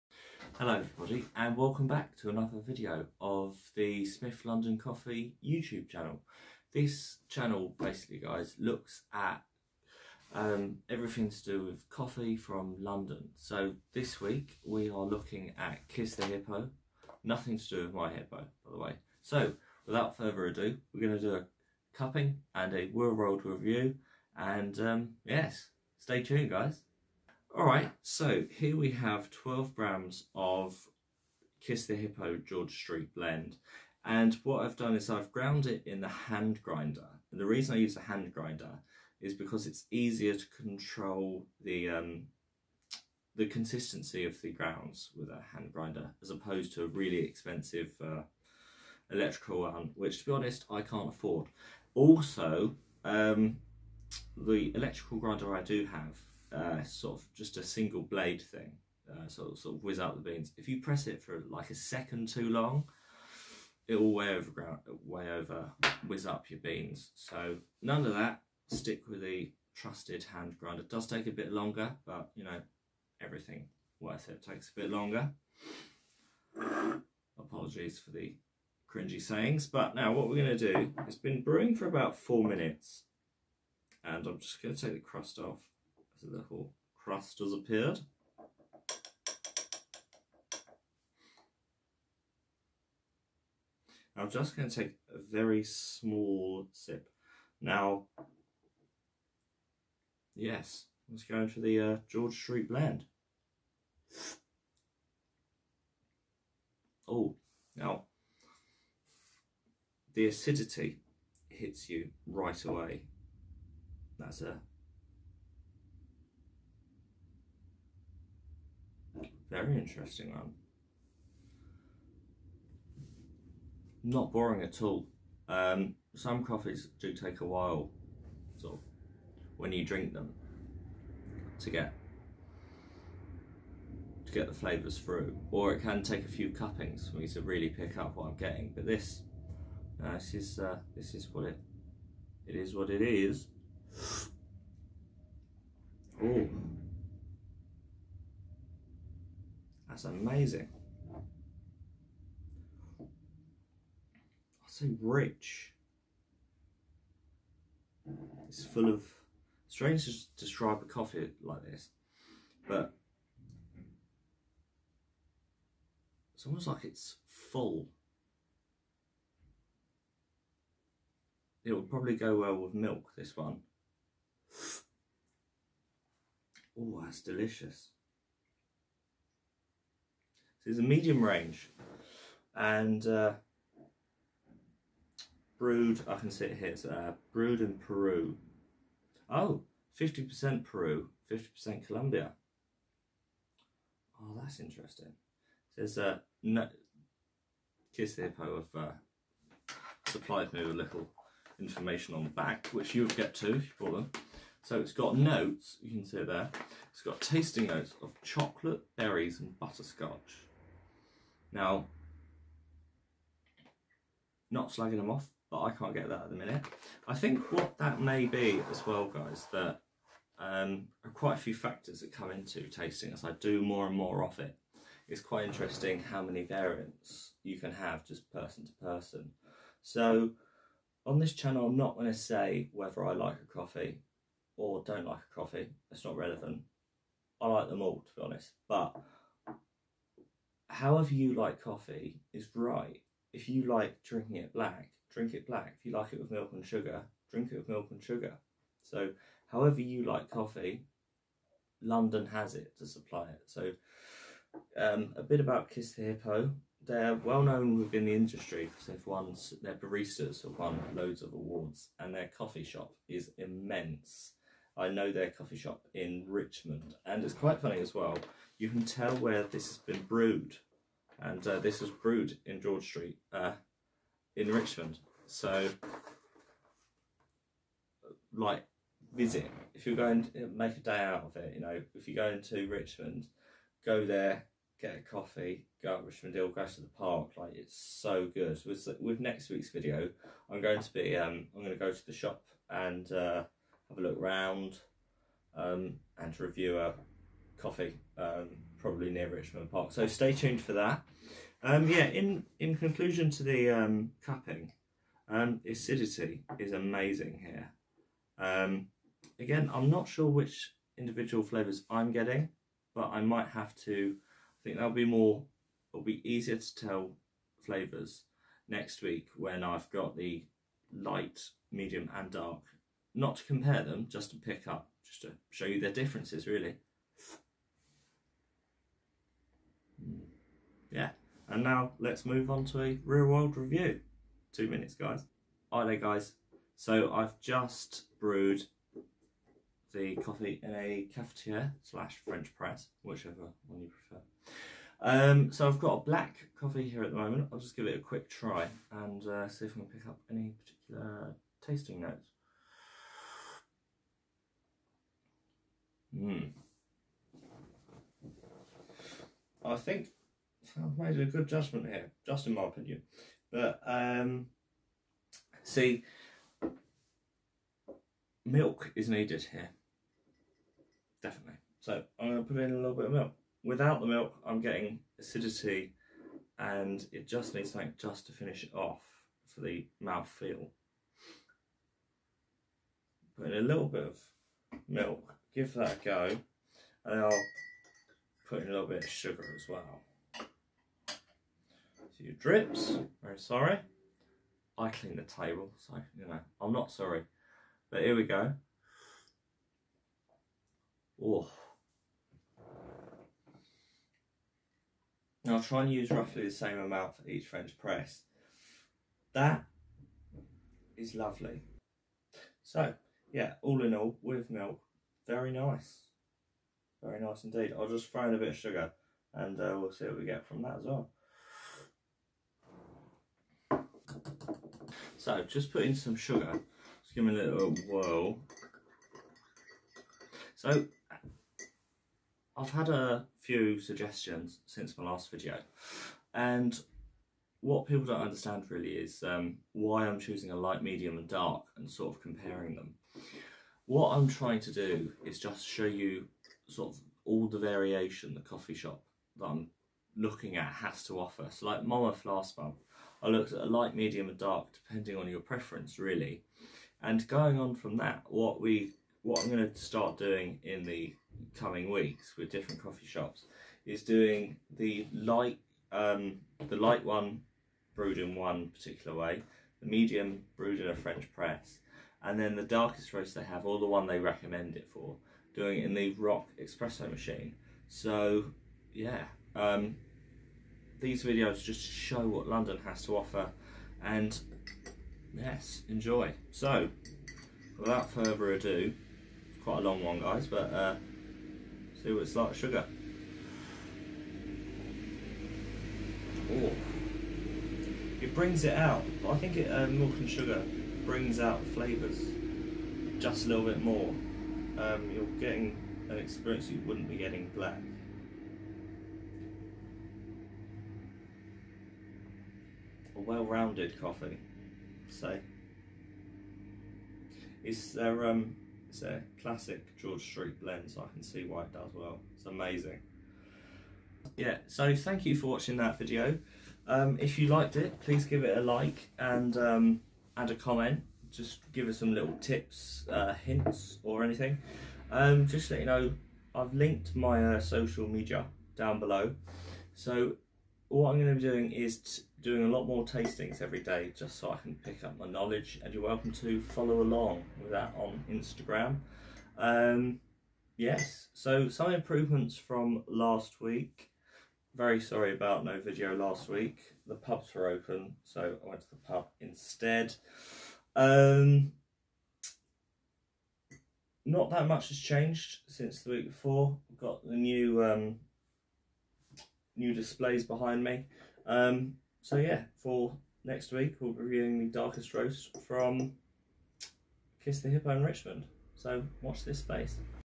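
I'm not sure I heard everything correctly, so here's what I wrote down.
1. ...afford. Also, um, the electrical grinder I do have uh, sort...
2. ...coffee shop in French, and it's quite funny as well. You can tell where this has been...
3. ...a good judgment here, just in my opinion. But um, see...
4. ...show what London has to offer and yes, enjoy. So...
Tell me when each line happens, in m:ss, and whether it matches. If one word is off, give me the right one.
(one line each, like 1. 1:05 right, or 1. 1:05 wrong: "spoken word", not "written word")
1. 0:51 right
2. 4:25 wrong: "Richmond", not "French"
3. 6:01 right
4. 8:01 right.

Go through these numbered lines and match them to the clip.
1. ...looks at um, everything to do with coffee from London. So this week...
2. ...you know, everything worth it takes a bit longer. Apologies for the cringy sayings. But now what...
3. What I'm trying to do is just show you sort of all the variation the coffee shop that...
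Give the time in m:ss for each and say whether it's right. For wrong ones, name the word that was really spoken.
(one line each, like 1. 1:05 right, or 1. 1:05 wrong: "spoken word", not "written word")
1. 0:08 right
2. 1:12 right
3. 7:23 right.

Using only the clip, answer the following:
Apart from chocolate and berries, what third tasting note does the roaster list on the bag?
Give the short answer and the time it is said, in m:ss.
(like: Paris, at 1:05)
butterscotch, at 3:29.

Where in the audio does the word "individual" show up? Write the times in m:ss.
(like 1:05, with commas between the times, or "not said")
5:10.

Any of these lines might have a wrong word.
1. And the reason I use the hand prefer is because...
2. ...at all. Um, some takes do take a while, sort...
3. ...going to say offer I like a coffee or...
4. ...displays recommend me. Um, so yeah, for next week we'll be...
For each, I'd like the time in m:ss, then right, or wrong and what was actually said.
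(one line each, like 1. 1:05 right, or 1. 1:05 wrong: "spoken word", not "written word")
1. 0:37 wrong: "grinder", not "prefer"
2. 2:04 wrong: "coffees", not "takes"
3. 3:51 wrong: "whether", not "offer"
4. 9:29 wrong: "behind", not "recommend".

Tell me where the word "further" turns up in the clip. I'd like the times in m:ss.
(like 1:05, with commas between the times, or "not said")
0:20, 8:08.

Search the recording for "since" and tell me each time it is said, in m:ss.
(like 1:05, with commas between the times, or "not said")
7:14, 9:25.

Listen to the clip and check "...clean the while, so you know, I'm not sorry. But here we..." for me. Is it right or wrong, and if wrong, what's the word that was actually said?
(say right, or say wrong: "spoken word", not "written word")
wrong: "table", not "while".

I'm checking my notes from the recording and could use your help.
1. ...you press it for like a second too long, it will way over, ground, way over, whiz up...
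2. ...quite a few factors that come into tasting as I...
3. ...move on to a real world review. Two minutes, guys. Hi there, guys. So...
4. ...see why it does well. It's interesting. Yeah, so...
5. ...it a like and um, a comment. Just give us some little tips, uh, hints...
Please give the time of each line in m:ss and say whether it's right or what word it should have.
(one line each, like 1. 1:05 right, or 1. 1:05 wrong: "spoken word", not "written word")
1. 1:00 right
2. 3:41 right
3. 5:32 right
4. 8:41 wrong: "amazing", not "interesting"
5. 8:48 right.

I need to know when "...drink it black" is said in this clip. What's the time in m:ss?
4:05.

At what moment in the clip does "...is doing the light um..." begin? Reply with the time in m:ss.
7:43.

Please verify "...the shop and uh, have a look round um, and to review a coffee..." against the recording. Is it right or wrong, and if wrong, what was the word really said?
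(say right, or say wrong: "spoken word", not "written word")
right.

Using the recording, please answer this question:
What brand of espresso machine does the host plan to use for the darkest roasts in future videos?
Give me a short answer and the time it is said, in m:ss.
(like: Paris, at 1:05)
ROK, at 7:56.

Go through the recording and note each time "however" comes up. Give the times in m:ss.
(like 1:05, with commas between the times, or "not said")
4:00, 4:09.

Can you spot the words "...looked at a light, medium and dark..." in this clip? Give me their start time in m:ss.
7:33.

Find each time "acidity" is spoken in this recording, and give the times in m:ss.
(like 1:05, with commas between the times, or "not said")
1:50, 5:05, 6:15.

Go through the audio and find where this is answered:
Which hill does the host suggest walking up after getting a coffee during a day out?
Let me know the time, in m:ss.
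4:46.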